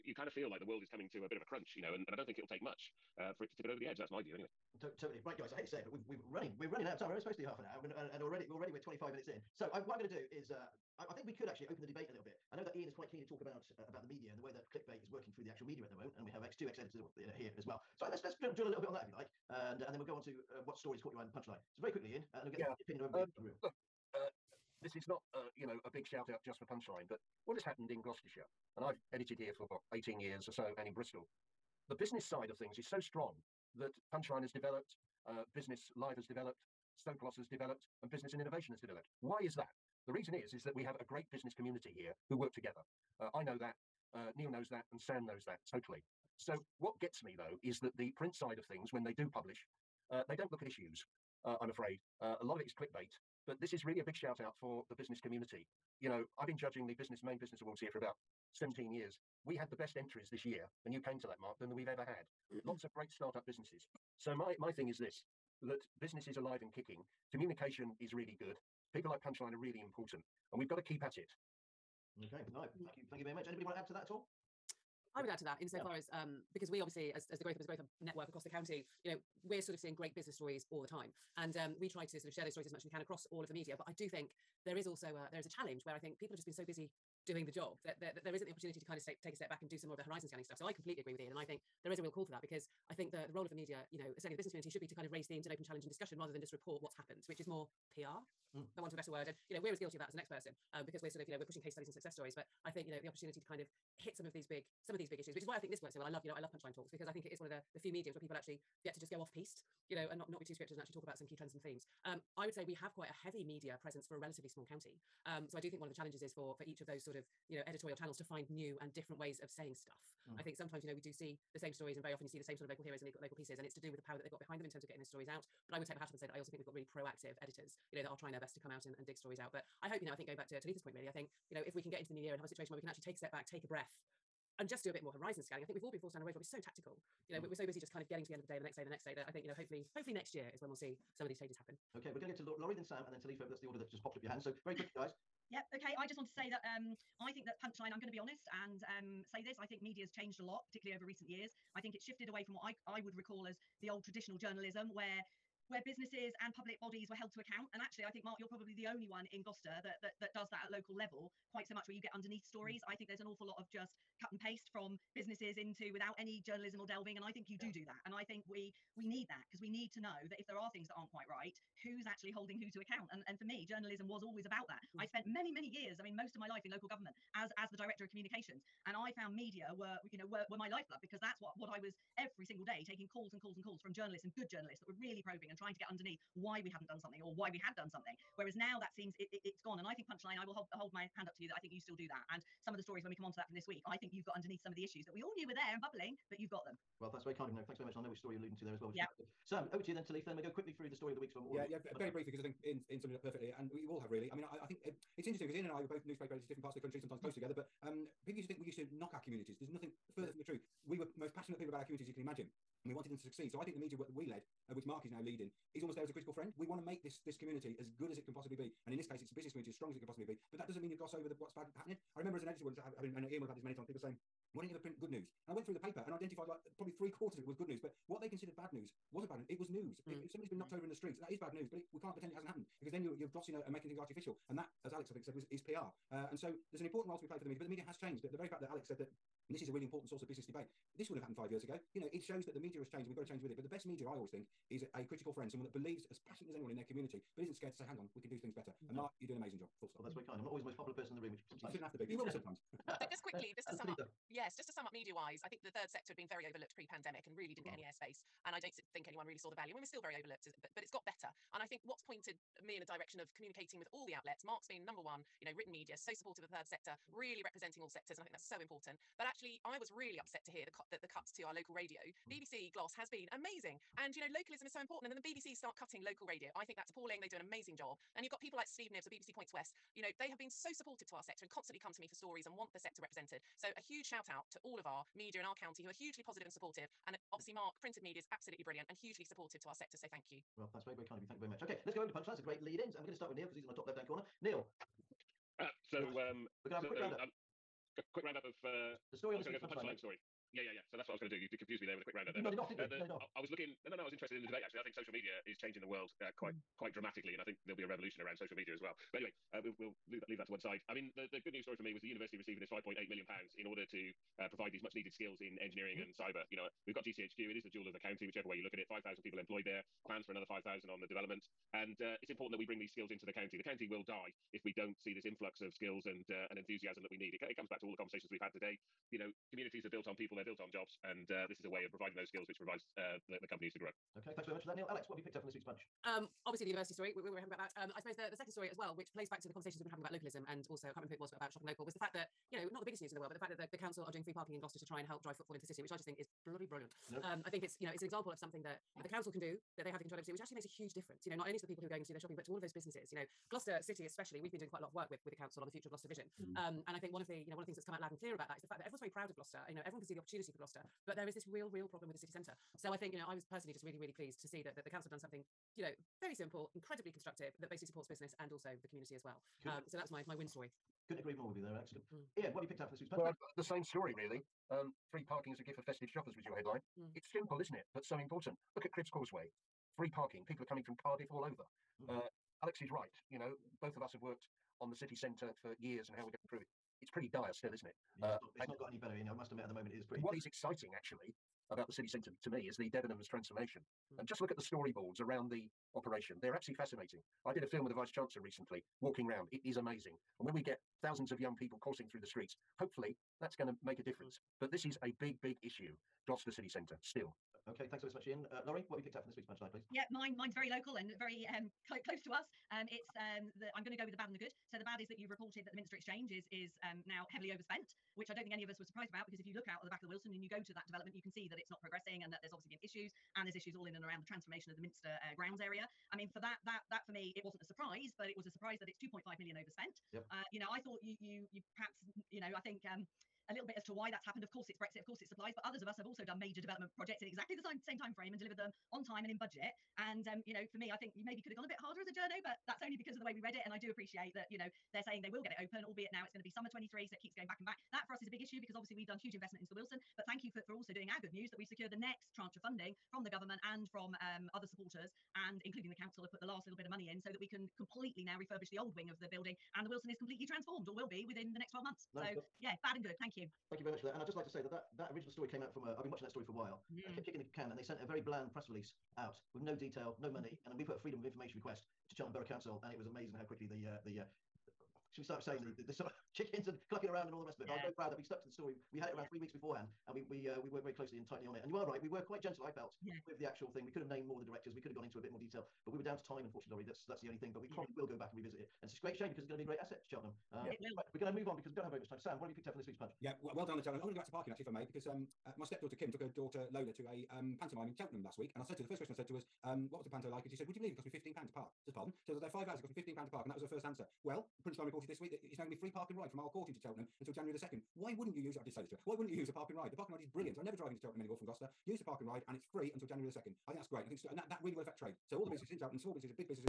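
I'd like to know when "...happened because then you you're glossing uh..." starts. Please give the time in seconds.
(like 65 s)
232 s.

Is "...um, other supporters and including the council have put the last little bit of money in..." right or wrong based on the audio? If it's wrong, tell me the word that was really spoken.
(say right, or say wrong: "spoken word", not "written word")
right.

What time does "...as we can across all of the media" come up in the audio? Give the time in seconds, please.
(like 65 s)
82 s.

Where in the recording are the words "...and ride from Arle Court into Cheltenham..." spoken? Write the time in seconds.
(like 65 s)
506 s.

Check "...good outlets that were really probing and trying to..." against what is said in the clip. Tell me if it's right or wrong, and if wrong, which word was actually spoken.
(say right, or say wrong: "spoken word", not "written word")
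wrong: "journalists", not "outlets".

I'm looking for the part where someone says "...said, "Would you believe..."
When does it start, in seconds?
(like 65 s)
500 s.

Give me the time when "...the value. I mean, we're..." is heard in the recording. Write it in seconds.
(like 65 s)
259 s.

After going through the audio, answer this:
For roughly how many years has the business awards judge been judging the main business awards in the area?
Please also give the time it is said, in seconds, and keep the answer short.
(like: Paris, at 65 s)
17, at 58 s.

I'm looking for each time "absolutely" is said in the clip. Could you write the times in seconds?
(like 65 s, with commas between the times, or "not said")
288 s, 396 s.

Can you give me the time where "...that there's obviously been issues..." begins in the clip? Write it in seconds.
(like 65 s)
422 s.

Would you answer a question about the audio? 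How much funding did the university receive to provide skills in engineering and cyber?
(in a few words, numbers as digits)
5.8 million pounds.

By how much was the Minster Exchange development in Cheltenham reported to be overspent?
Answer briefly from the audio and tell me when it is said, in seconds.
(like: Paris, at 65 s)
2.5 million, at 428 s.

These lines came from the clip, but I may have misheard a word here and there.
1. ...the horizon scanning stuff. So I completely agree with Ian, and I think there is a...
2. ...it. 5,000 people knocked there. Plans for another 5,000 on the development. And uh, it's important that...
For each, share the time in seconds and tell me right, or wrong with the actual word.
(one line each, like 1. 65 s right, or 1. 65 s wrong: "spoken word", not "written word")
1. 89 s right
2. 318 s wrong: "employed", not "knocked".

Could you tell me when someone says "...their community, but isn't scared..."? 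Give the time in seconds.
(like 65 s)
246 s.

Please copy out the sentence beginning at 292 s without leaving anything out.
And we're going to start with Neill because he's in my top left hand corner.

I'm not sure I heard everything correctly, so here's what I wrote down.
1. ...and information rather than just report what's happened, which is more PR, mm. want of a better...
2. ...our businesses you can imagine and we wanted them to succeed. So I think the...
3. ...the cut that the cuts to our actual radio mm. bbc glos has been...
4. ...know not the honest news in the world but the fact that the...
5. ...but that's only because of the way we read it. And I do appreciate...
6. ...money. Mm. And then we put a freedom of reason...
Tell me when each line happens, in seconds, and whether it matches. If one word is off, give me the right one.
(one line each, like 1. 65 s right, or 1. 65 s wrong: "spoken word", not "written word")
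1. 95 s wrong: "discussion", not "information"
2. 211 s wrong: "communities", not "businesses"
3. 270 s wrong: "local", not "actual"
4. 342 s wrong: "biggest", not "honest"
5. 442 s right
6. 470 s wrong: "information", not "reason".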